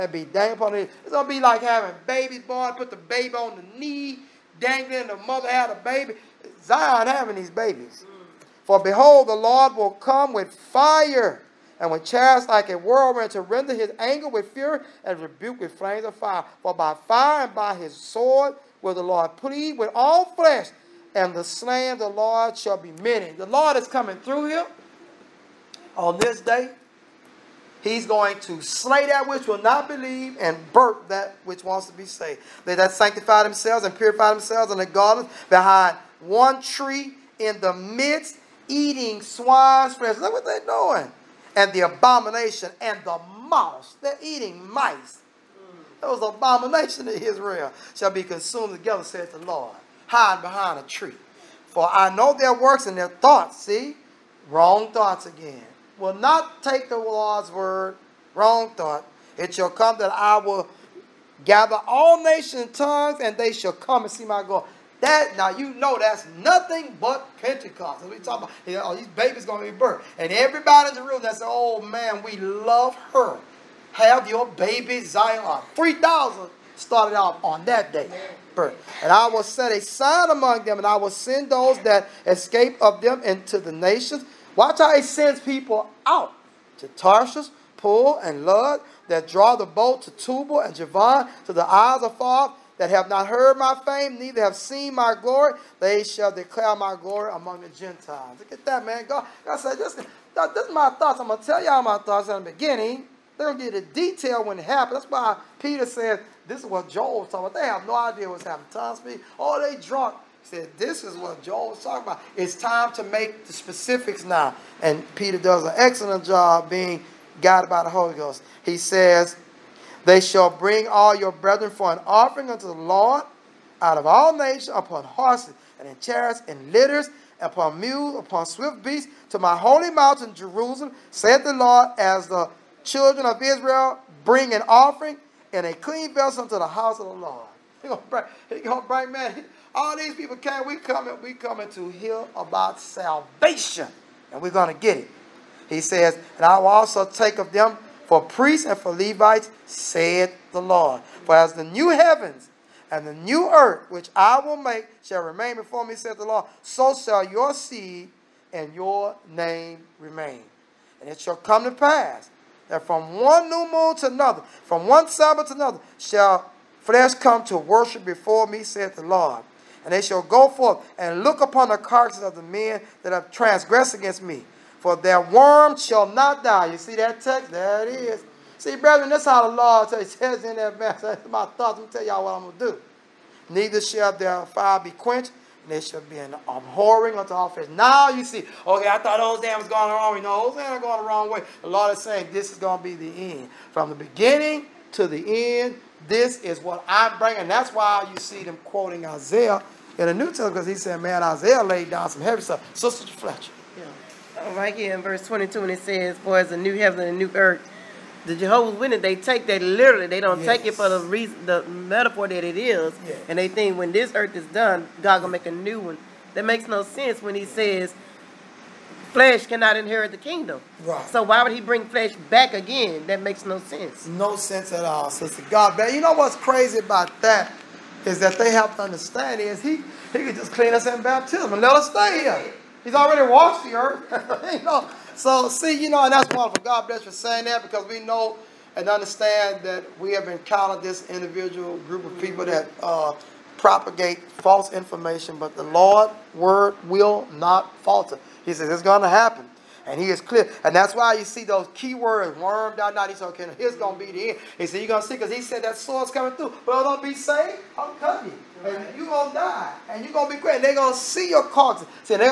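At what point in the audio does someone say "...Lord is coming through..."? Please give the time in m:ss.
0:23.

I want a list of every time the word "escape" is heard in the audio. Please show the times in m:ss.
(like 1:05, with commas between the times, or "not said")
1:22.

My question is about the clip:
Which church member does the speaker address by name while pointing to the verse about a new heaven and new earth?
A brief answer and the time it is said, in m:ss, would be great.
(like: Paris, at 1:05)
Sister Fletcher, at 3:22.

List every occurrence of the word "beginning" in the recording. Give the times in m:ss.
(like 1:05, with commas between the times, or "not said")
1:42, 3:13.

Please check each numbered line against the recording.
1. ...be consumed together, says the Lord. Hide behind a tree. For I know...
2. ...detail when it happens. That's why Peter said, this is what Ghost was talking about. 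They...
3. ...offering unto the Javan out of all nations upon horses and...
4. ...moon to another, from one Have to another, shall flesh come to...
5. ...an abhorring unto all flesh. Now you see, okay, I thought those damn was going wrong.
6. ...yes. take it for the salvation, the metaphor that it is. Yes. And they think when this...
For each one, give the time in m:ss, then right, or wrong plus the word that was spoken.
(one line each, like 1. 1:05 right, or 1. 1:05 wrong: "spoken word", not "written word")
1. 0:48 right
2. 1:43 wrong: "Joel", not "Ghost"
3. 2:02 wrong: "Lord", not "Javan"
4. 2:43 wrong: "Sabbath", not "Have"
5. 3:06 right
6. 3:30 wrong: "reason", not "salvation".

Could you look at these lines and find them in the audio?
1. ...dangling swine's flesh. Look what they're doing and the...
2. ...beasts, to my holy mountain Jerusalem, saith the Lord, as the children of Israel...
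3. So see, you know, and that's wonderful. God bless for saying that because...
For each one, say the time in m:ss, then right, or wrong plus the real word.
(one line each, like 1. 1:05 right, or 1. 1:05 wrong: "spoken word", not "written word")
1. 0:38 wrong: "eating", not "dangling"
2. 2:08 right
3. 3:55 right.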